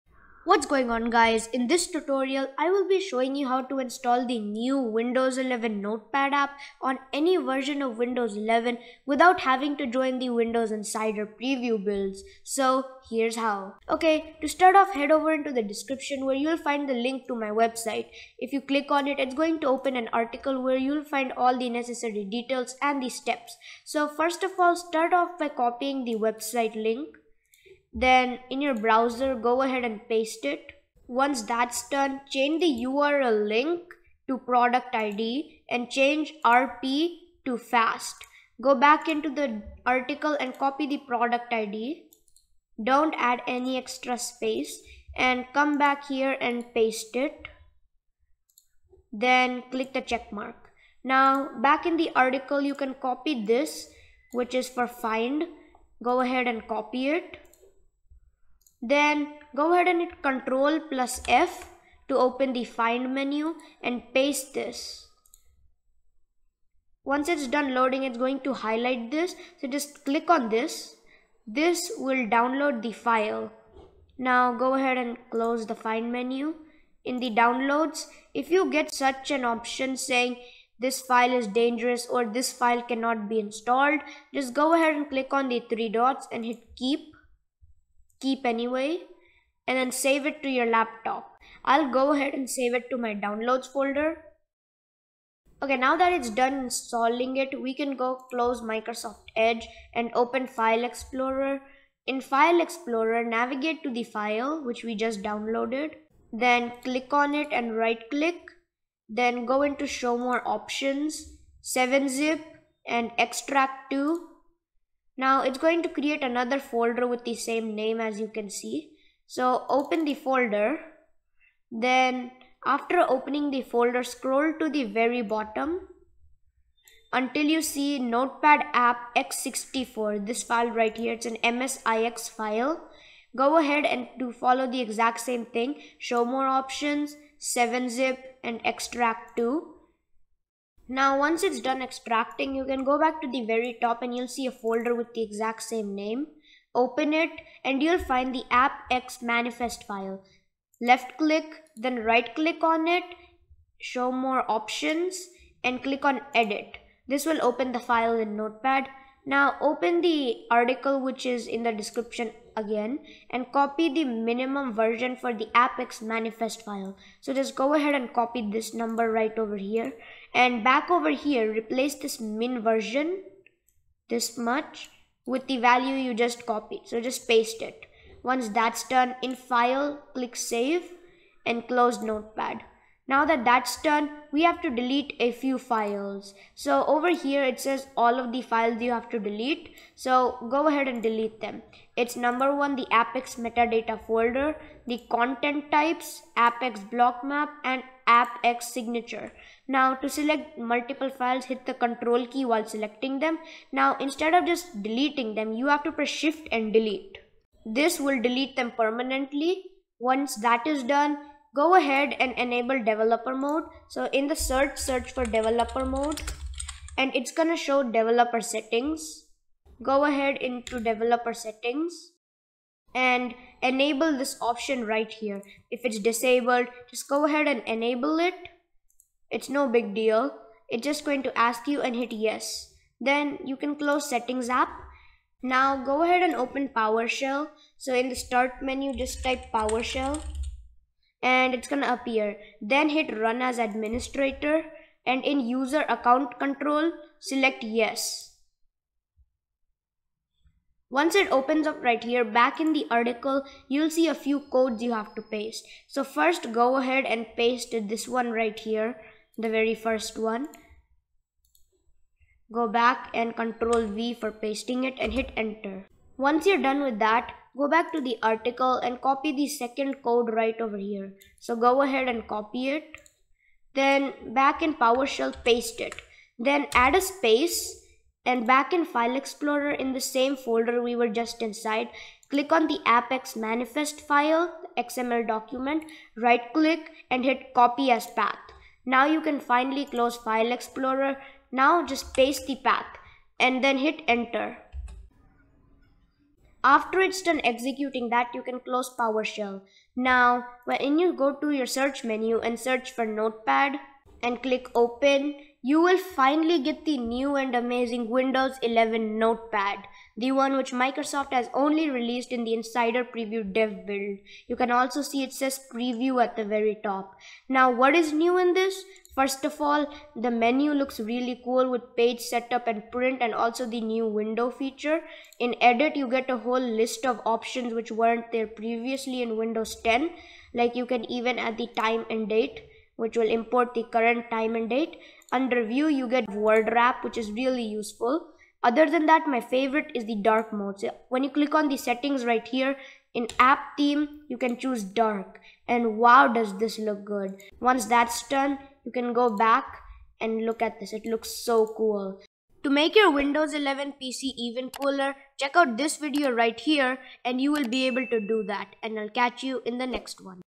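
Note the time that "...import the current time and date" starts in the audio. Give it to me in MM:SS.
05:33.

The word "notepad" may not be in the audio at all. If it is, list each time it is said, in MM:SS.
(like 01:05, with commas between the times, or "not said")
00:05, 02:07, 02:38, 03:02, 05:03, 05:09.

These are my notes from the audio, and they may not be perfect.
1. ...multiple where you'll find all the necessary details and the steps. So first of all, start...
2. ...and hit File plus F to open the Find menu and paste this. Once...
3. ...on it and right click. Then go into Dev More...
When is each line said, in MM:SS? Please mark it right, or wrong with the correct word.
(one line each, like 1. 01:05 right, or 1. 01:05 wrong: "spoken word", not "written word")
1. 00:20 wrong: "article", not "multiple"
2. 00:59 wrong: "Control", not "File"
3. 01:47 wrong: "Show", not "Dev".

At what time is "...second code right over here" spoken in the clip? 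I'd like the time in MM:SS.
04:29.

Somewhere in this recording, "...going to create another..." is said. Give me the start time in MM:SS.
01:55.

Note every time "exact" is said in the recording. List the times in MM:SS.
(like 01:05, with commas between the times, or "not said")
02:14, 02:25.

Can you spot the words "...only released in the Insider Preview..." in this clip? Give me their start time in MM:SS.
05:11.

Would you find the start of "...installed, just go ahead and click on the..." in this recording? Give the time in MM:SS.
01:23.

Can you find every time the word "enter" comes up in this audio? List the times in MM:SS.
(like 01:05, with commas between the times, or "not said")
04:25, 04:54.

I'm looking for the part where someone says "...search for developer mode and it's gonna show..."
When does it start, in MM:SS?
03:34.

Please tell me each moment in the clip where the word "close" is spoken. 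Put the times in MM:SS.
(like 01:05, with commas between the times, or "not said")
01:15, 01:38, 03:01, 03:53, 04:49, 04:58.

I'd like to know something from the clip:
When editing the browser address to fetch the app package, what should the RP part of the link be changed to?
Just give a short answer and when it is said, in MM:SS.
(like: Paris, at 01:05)
fast, at 00:35.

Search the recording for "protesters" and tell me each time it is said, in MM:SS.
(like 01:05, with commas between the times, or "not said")
not said.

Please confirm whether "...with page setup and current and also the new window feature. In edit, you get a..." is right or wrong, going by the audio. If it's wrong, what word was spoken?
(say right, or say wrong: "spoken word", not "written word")
wrong: "print", not "current".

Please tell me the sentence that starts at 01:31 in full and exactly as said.
I'll go ahead and save it to my downloads folder.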